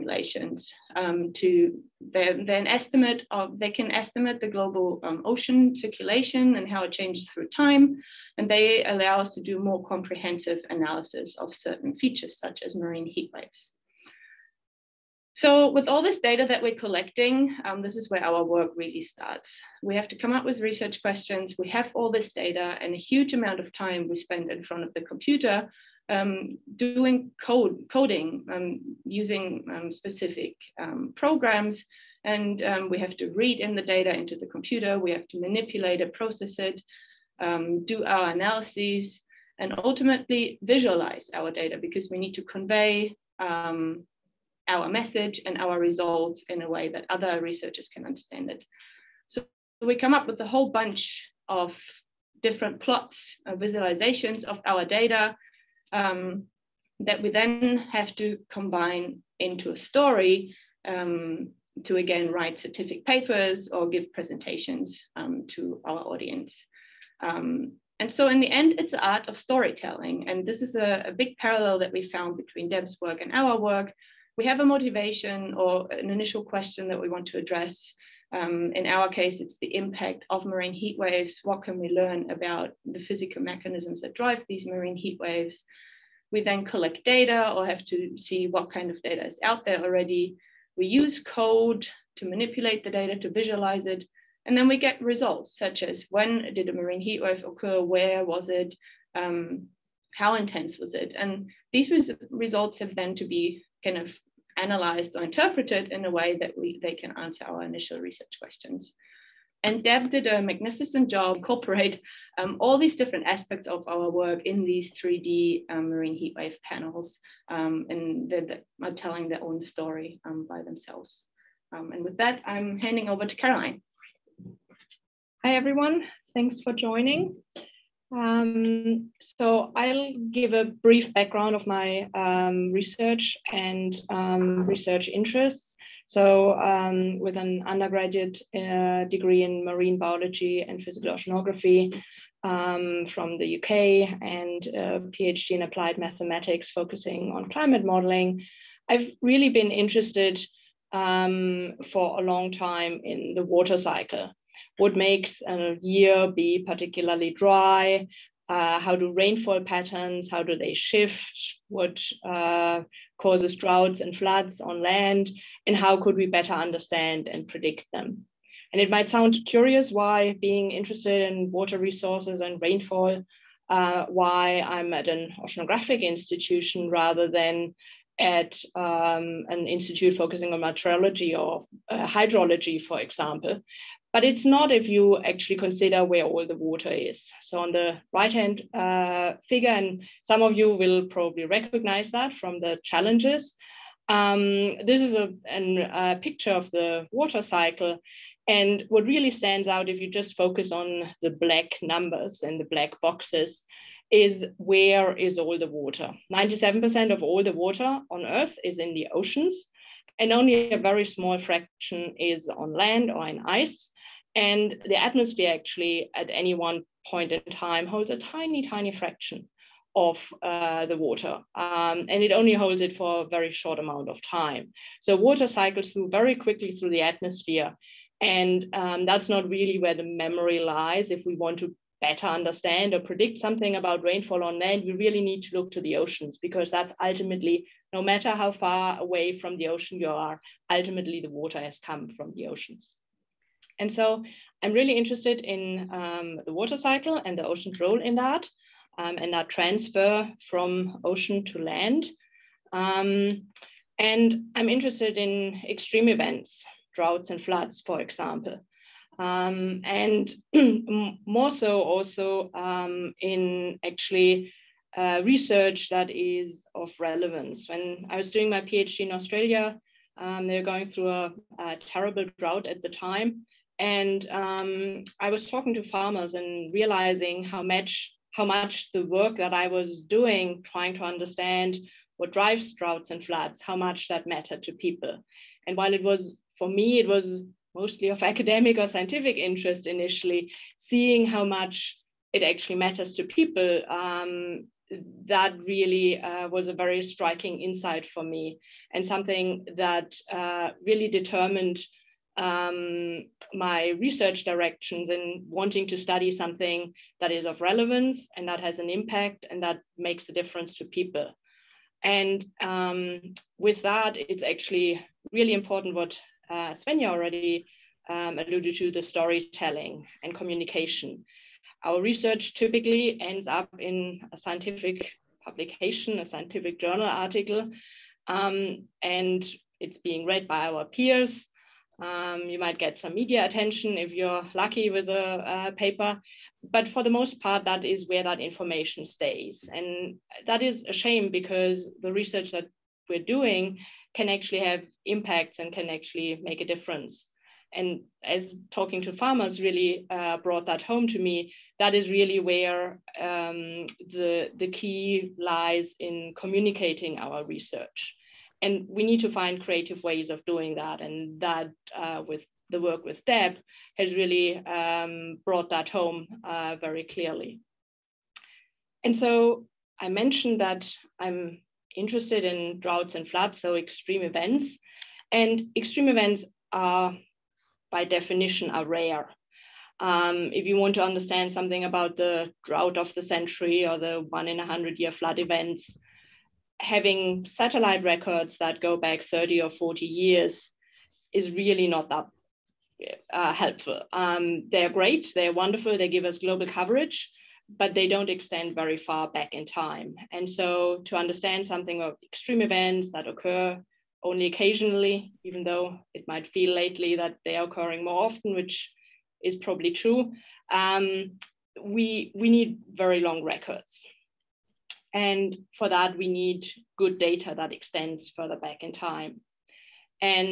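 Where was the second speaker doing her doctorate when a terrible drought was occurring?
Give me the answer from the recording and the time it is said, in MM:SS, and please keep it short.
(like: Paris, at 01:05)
Australia, at 04:29.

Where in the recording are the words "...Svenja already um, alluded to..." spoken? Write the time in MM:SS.
05:16.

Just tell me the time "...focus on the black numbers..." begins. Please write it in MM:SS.
03:20.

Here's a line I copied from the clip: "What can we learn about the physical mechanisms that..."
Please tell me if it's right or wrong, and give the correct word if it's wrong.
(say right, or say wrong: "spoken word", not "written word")
right.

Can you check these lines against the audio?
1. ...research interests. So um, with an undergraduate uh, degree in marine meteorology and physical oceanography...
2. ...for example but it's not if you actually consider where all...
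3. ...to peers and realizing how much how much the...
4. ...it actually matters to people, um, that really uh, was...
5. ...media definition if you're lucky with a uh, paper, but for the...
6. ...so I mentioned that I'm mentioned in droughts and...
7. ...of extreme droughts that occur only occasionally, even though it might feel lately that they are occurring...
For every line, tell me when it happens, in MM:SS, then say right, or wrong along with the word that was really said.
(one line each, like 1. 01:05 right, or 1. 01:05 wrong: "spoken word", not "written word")
1. 02:14 wrong: "biology", not "meteorology"
2. 03:02 right
3. 04:35 wrong: "farmers", not "peers"
4. 04:52 right
5. 05:33 wrong: "attention", not "definition"
6. 06:09 wrong: "interested", not "mentioned"
7. 06:42 wrong: "events", not "droughts".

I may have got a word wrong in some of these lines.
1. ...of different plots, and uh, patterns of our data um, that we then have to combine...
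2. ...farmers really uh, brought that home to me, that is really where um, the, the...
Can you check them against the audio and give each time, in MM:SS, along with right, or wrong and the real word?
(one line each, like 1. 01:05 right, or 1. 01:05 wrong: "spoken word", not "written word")
1. 00:51 wrong: "visualizations", not "patterns"
2. 05:49 right.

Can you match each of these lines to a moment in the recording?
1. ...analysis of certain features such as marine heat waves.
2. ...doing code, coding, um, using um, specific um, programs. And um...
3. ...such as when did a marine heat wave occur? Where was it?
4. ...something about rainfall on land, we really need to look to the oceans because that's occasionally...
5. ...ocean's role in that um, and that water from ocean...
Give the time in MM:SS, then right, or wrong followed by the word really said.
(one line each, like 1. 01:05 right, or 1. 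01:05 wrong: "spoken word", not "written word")
1. 00:10 right
2. 00:26 right
3. 01:35 right
4. 03:53 wrong: "ultimately", not "occasionally"
5. 04:07 wrong: "transfer", not "water".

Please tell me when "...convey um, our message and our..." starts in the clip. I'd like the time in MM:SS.
00:42.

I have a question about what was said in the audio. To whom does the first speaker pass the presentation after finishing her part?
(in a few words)
Caroline.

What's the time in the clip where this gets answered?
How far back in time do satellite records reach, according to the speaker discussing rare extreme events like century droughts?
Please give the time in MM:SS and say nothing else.
06:29.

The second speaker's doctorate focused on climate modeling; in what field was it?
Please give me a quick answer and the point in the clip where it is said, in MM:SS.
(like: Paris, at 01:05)
Applied mathematics, at 02:25.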